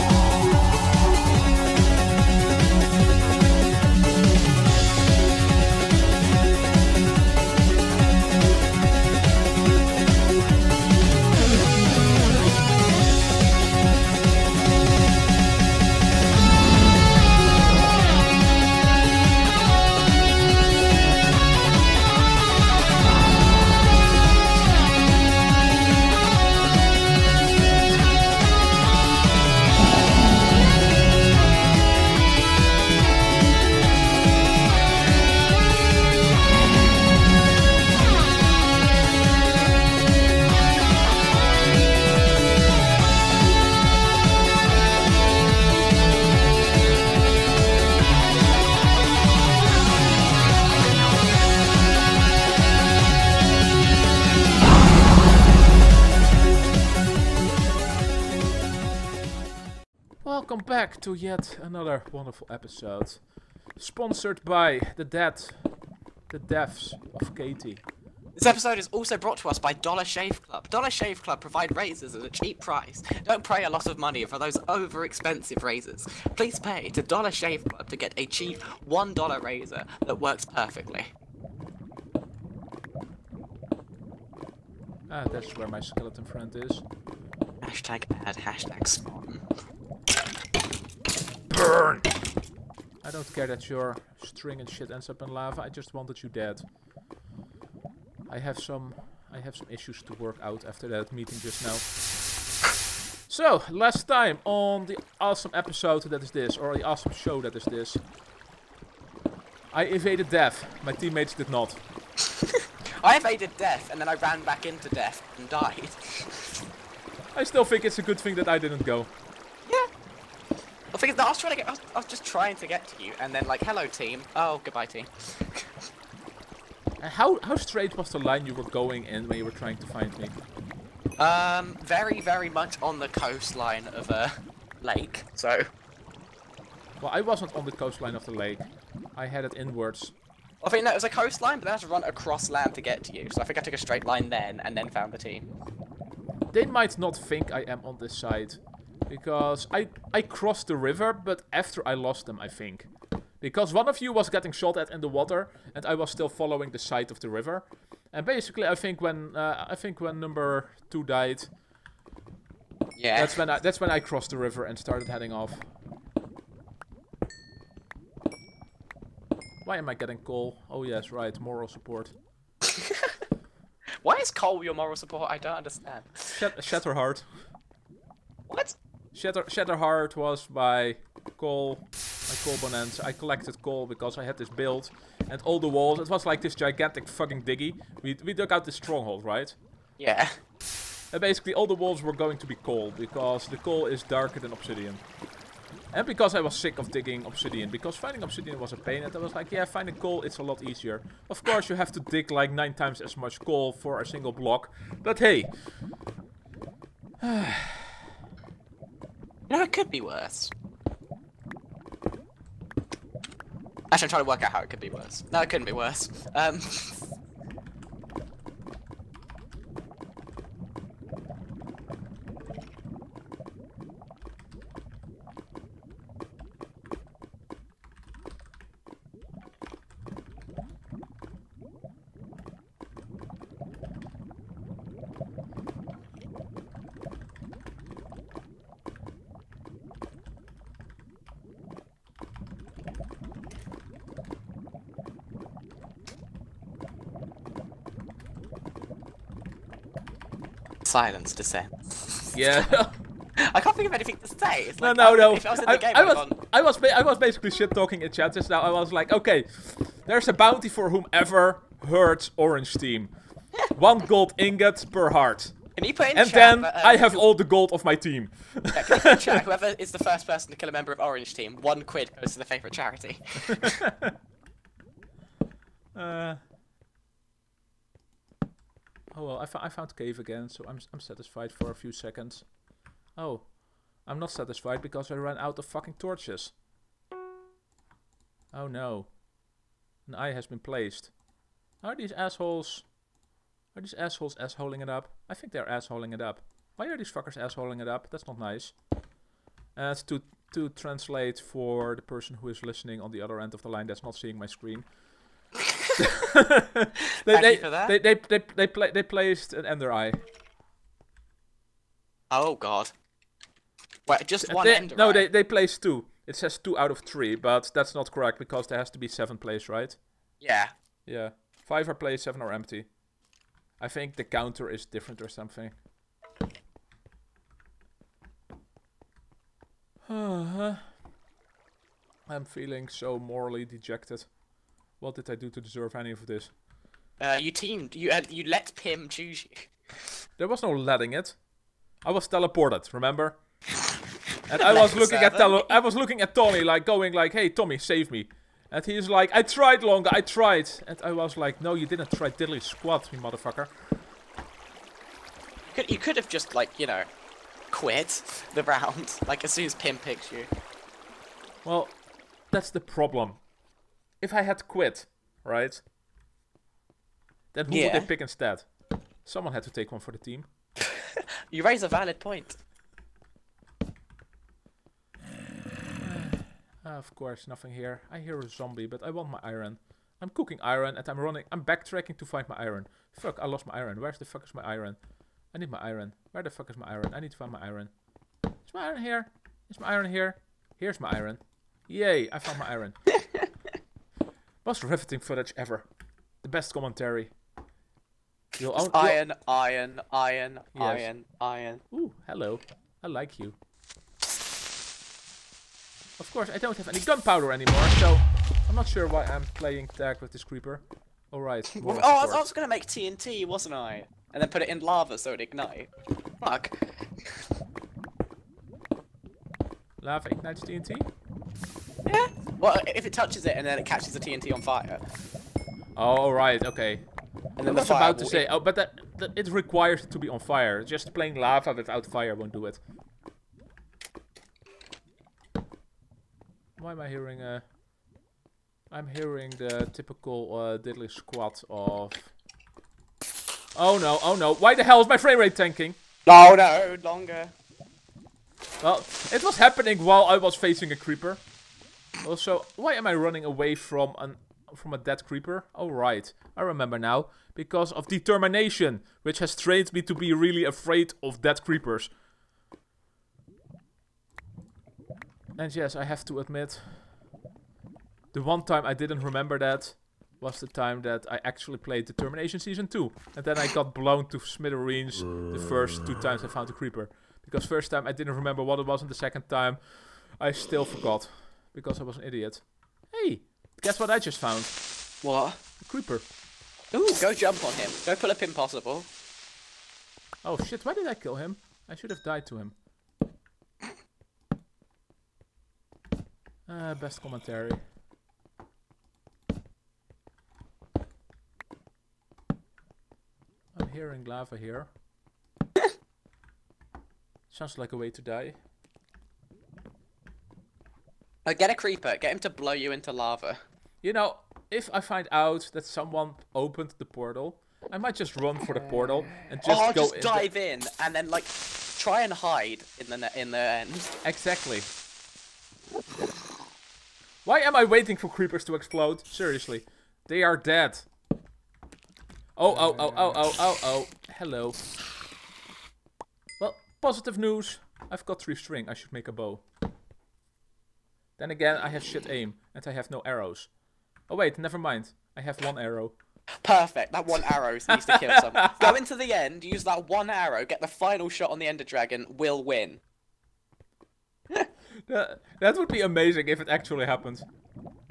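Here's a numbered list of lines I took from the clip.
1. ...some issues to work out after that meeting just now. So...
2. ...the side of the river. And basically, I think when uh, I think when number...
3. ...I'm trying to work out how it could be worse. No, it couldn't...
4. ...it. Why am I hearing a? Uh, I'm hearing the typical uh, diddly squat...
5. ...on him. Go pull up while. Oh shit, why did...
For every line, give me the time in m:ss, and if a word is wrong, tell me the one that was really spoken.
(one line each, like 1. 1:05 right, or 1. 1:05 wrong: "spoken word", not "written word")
1. 1:39 right
2. 2:36 right
3. 3:34 right
4. 7:12 right
5. 8:07 wrong: "impossible", not "while".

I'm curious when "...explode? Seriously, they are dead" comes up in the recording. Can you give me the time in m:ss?
8:48.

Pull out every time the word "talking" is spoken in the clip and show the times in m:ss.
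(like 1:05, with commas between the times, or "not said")
4:17.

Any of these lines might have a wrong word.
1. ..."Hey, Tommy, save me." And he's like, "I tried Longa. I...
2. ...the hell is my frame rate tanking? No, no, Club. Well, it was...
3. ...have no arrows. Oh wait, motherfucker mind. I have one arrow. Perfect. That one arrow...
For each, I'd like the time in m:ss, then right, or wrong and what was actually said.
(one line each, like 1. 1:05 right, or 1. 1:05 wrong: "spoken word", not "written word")
1. 5:47 right
2. 7:24 wrong: "Longa", not "Club"
3. 9:02 wrong: "never", not "motherfucker".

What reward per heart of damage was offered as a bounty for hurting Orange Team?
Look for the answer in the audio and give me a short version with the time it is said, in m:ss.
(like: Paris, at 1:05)
One gold ingot, at 4:23.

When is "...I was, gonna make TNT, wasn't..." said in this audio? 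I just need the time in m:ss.
6:52.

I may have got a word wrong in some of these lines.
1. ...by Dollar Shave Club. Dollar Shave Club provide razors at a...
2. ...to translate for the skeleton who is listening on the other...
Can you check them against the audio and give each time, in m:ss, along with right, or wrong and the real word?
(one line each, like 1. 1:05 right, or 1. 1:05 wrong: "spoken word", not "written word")
1. 1:09 right
2. 5:00 wrong: "person", not "skeleton".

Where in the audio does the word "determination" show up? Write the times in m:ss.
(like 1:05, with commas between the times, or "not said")
7:38, 7:52.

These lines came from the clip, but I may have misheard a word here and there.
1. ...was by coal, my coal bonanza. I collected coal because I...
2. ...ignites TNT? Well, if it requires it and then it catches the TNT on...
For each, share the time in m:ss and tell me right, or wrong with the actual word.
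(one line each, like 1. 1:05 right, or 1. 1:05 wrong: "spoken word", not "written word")
1. 3:00 right
2. 7:00 wrong: "touches", not "requires".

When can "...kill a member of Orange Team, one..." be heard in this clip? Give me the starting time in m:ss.
4:30.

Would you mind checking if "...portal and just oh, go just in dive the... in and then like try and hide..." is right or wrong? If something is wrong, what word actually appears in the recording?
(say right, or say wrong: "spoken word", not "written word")
right.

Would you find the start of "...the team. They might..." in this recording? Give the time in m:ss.
2:25.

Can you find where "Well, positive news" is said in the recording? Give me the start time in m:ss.
8:56.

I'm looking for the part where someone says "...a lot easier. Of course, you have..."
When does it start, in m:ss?
3:20.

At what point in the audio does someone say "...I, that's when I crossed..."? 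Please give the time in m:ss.
2:43.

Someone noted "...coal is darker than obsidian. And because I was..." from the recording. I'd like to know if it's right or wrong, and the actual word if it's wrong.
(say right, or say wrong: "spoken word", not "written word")
right.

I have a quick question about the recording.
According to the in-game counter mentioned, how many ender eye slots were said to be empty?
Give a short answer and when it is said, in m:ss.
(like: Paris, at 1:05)
7, at 5:22.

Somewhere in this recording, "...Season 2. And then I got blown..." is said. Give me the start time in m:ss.
7:52.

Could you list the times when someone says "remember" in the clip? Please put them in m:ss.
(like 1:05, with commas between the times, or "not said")
5:42, 7:36, 7:49, 7:58.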